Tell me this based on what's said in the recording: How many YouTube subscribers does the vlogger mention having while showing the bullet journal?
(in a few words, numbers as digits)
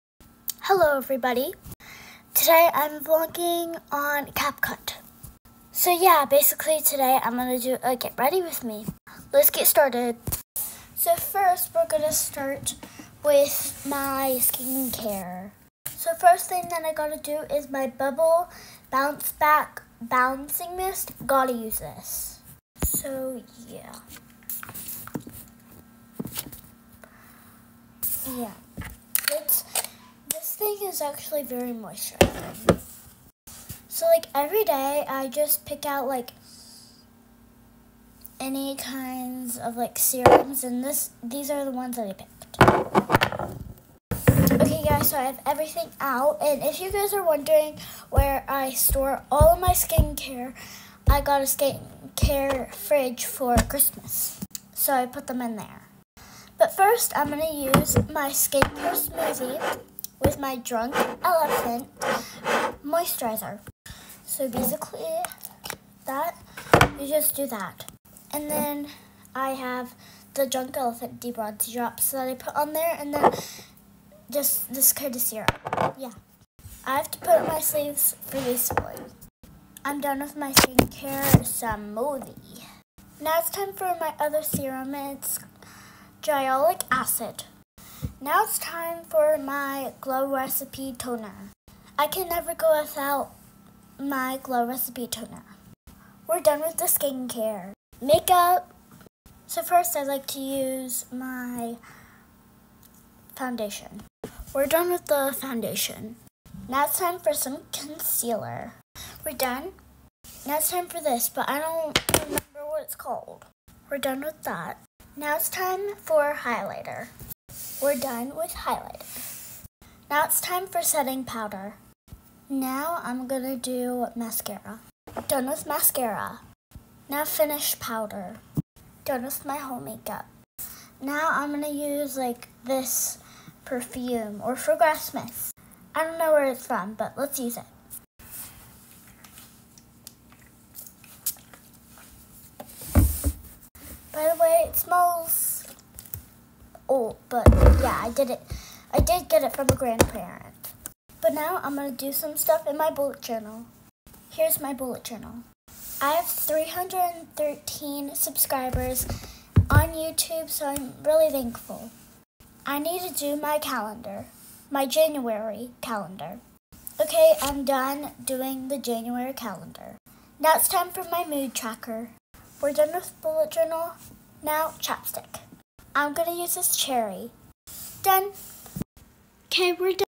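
313.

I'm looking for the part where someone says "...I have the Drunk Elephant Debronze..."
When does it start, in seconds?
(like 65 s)
69 s.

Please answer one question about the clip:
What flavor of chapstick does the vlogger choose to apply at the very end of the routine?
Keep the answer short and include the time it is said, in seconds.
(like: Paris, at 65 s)
cherry, at 176 s.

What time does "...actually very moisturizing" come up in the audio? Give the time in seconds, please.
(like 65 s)
31 s.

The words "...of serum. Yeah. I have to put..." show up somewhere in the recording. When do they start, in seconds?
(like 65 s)
75 s.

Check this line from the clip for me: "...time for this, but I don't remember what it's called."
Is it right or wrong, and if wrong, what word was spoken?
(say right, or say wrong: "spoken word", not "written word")
right.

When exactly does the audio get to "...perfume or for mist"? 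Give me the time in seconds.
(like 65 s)
133 s.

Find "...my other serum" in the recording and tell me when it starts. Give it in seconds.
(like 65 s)
83 s.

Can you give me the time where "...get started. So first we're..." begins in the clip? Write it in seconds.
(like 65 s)
9 s.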